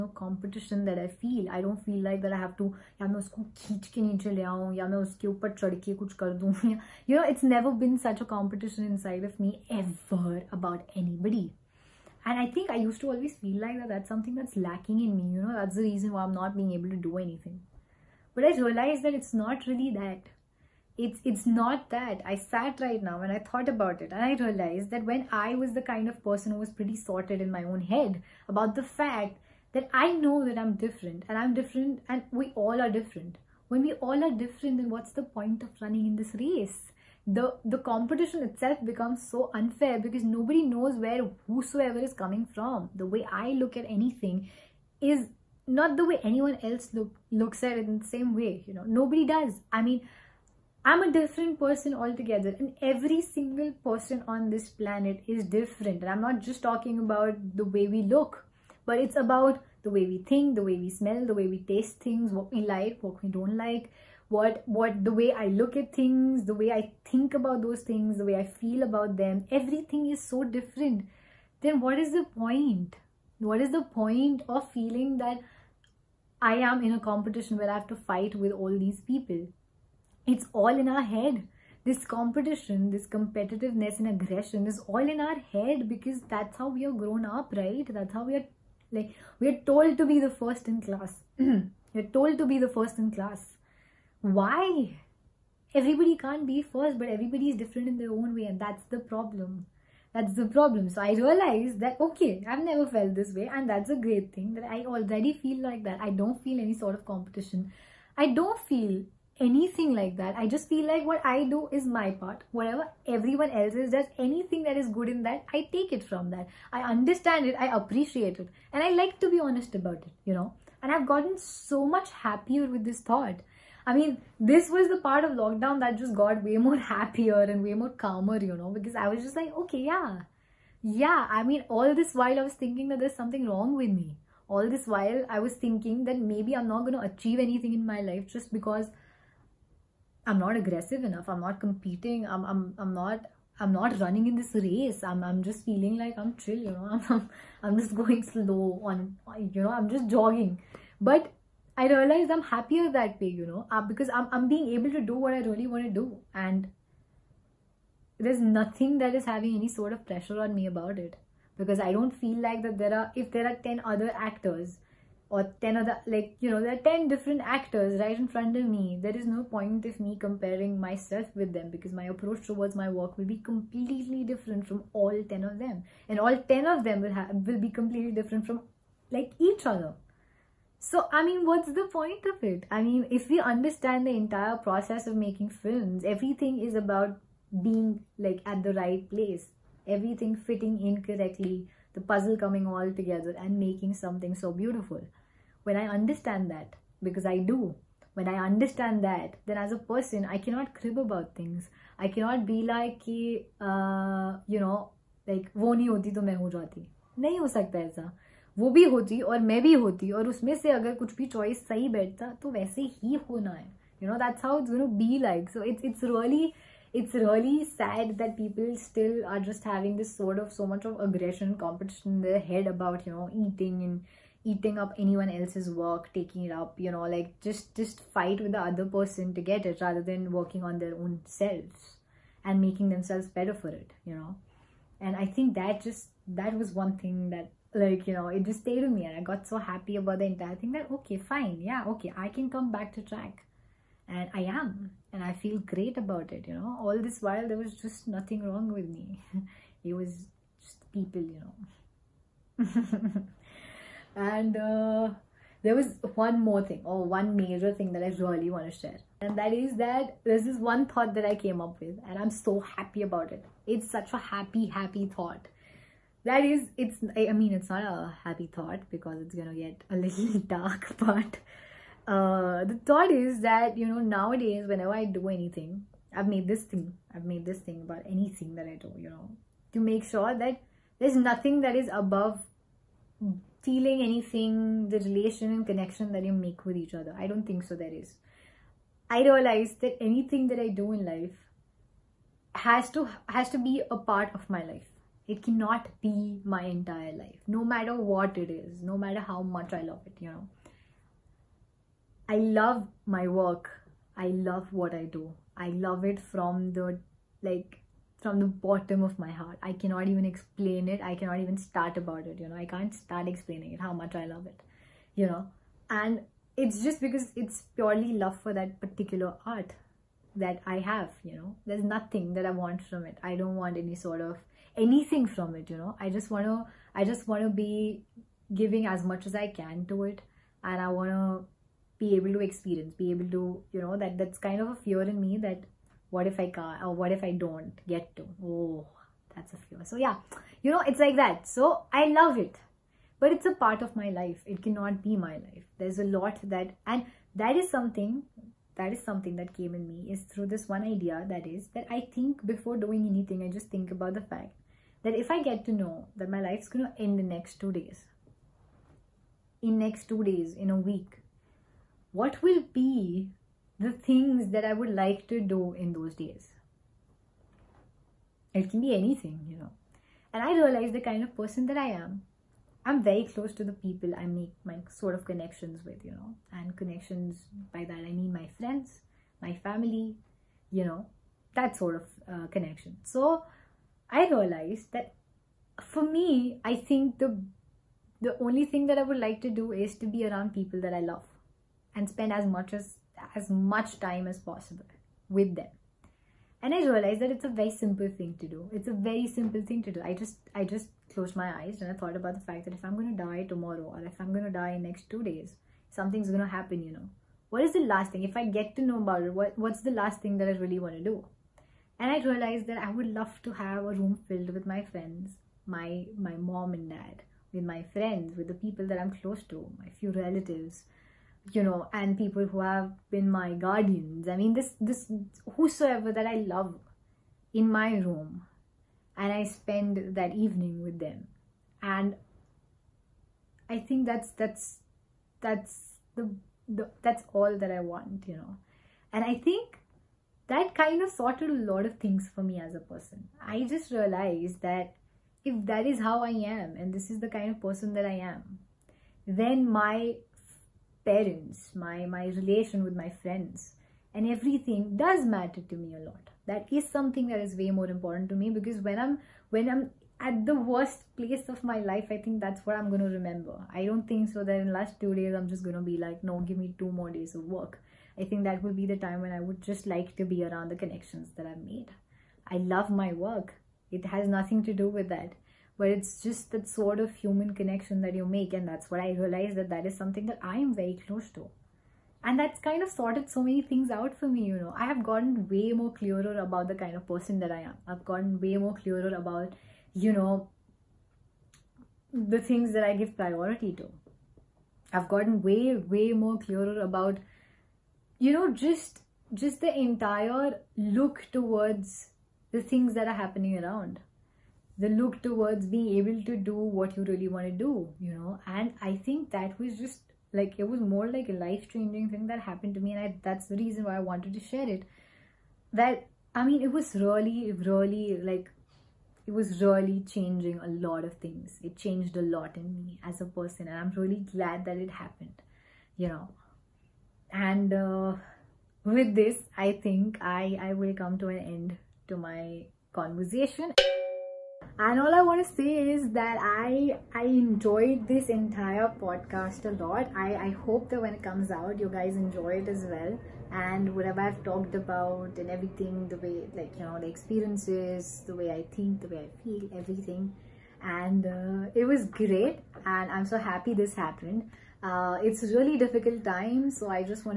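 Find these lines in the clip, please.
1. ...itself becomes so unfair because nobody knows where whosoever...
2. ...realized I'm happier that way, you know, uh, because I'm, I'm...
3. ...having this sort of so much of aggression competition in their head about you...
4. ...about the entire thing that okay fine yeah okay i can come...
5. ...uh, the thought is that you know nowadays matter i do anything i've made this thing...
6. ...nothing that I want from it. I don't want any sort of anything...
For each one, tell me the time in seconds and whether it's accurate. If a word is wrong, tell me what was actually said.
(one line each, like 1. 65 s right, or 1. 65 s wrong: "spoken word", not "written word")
1. 38 s right
2. 151 s right
3. 219 s right
4. 239 s right
5. 272 s wrong: "whenever", not "matter"
6. 321 s right.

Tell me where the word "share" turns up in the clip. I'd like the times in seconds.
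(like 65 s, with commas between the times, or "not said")
258 s, 514 s.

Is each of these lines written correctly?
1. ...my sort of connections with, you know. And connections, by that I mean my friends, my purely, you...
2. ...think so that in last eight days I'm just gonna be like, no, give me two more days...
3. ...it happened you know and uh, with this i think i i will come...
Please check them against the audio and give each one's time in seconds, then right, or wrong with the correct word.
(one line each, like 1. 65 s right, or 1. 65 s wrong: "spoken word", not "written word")
1. 374 s wrong: "family", not "purely"
2. 464 s wrong: "two", not "eight"
3. 524 s right.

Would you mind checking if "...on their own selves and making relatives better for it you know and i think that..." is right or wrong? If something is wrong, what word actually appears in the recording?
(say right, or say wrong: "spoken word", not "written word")
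wrong: "themselves", not "relatives".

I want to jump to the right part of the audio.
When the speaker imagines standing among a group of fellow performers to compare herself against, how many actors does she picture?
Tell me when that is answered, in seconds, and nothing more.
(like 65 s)
163 s.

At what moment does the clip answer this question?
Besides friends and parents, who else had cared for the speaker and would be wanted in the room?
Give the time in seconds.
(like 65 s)
423 s.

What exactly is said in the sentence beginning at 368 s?
It can be anything, you know.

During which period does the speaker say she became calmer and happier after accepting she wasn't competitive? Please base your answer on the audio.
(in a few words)
Lockdown.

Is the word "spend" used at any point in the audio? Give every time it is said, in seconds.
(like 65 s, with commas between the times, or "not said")
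392 s, 429 s.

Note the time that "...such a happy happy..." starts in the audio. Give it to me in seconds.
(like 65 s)
263 s.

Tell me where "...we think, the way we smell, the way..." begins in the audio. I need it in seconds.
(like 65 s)
60 s.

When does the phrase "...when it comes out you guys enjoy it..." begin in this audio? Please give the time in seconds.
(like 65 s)
540 s.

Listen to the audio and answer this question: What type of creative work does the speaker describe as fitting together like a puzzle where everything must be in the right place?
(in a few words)
Films.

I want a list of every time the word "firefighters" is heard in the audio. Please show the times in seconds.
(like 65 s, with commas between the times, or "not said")
not said.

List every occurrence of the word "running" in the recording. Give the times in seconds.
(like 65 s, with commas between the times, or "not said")
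35 s, 143 s.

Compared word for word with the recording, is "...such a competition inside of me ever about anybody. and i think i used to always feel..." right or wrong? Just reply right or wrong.
right.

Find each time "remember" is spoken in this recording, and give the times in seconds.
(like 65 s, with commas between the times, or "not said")
463 s.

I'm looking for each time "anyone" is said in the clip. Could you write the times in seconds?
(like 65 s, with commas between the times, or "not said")
46 s, 225 s.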